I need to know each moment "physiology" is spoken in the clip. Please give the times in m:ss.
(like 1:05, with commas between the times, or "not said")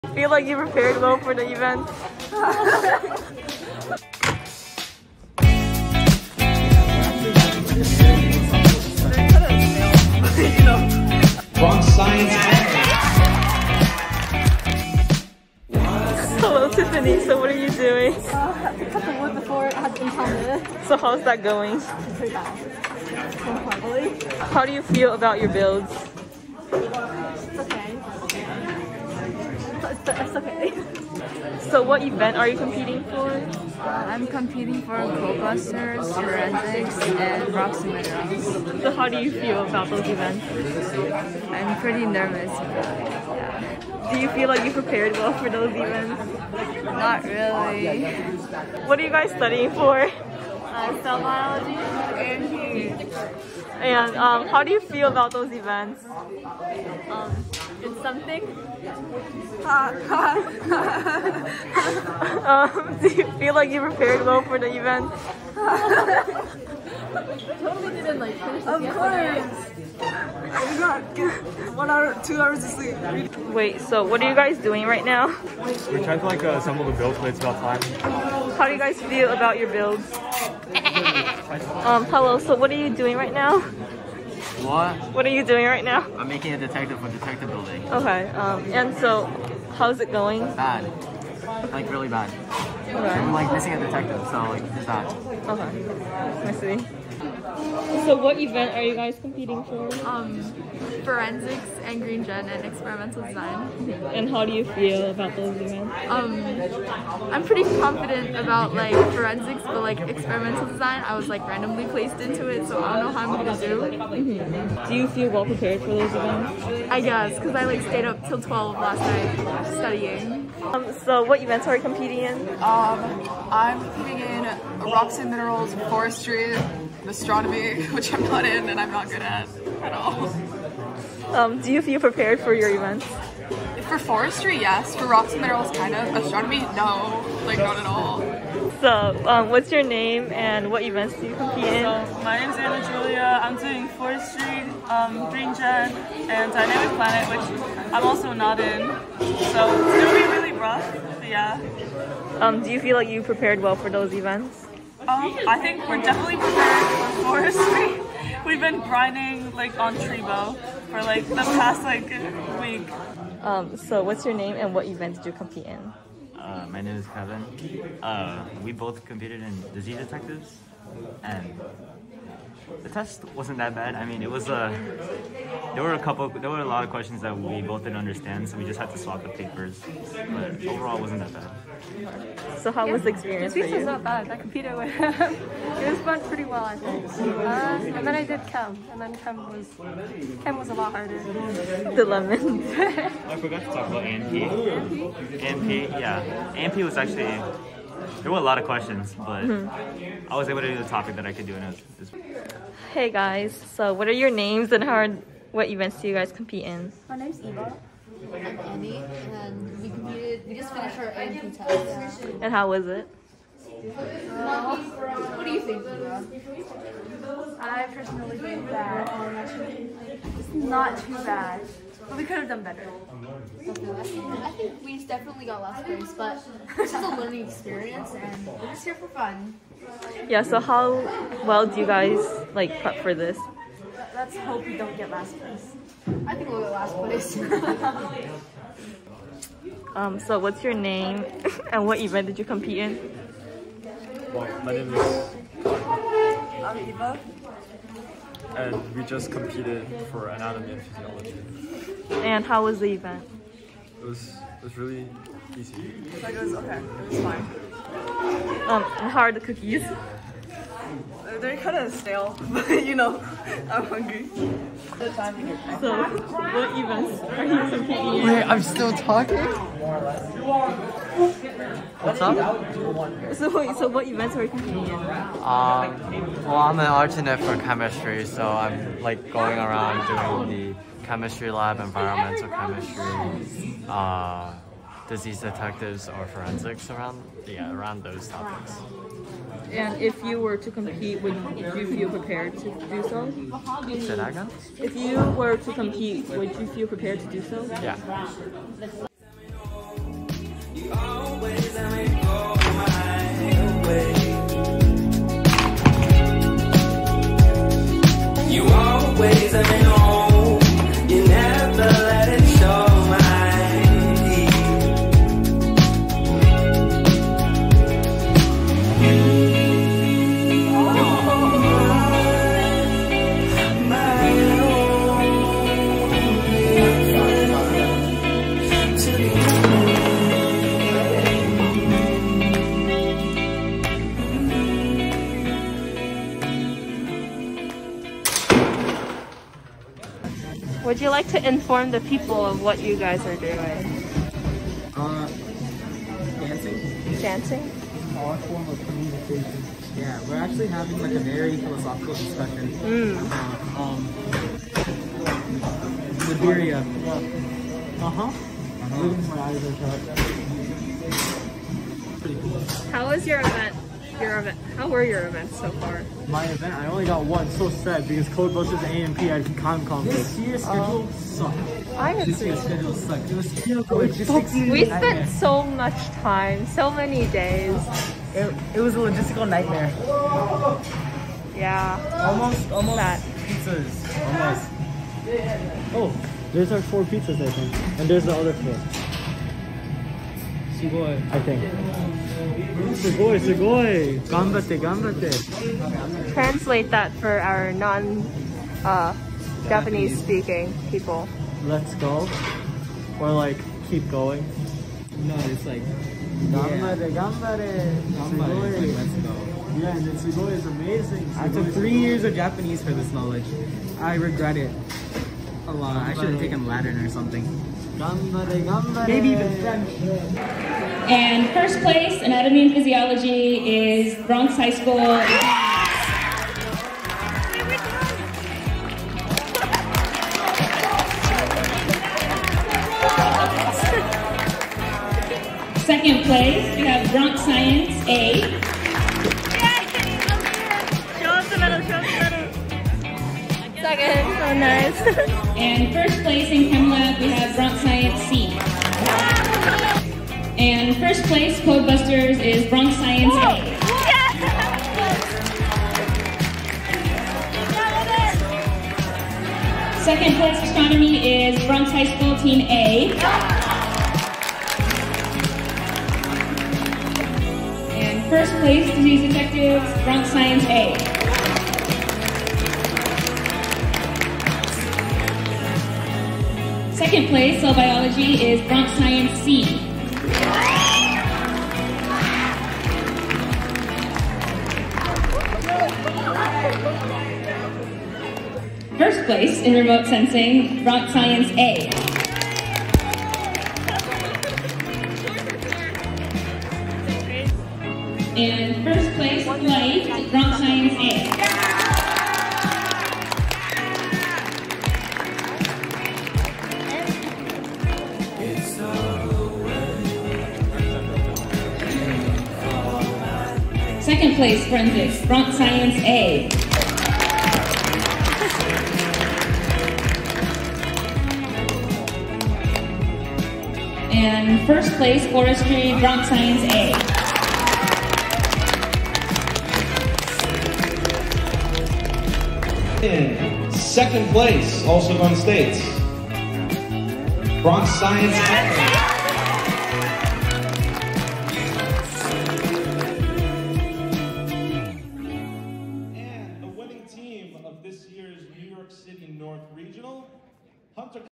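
4:10, 7:02.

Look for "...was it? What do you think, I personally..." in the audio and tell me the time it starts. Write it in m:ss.
3:32.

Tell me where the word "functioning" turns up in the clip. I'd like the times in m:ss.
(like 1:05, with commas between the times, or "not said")
not said.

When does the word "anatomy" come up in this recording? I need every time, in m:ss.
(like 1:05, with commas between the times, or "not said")
4:10, 7:02.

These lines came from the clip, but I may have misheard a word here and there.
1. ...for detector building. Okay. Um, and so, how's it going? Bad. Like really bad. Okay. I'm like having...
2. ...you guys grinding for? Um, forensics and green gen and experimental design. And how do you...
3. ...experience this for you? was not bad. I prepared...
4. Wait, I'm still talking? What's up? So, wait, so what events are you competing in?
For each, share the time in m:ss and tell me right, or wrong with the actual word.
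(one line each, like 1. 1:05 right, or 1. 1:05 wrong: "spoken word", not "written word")
1. 1:26 wrong: "missing", not "having"
2. 1:38 wrong: "competing", not "grinding"
3. 3:03 wrong: "competed", not "prepared"
4. 4:28 right.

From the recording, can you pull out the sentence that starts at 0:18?
Uh, I cut the wood before it had impounded.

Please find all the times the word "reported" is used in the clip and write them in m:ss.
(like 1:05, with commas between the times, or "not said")
not said.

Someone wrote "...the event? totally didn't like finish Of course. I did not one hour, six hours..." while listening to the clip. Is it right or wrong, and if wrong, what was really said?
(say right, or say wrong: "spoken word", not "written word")
wrong: "two", not "six".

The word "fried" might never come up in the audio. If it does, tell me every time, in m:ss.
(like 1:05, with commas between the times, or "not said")
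not said.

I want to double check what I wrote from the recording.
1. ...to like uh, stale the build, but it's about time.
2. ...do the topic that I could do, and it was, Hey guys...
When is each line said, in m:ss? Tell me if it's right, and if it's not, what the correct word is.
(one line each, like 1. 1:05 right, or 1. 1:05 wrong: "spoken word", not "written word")
1. 1:16 wrong: "assemble", not "stale"
2. 3:20 right.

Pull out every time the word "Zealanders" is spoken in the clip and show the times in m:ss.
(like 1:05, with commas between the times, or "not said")
not said.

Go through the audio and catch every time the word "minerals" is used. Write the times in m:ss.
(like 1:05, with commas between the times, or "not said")
0:37, 2:05, 2:15.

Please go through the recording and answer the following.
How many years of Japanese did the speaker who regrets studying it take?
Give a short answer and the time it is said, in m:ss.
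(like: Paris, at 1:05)
3, at 6:51.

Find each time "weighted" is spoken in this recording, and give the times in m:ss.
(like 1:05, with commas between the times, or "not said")
not said.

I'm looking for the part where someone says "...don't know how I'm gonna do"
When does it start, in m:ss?
1:52.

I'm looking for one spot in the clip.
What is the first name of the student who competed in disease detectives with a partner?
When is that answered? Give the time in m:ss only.
2:47.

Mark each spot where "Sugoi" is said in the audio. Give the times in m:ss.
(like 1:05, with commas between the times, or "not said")
6:33, 6:51.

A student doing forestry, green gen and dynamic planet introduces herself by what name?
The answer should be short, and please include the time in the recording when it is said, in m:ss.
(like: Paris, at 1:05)
Anna Giulia, at 2:22.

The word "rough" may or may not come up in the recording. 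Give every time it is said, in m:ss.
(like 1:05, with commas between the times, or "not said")
2:30.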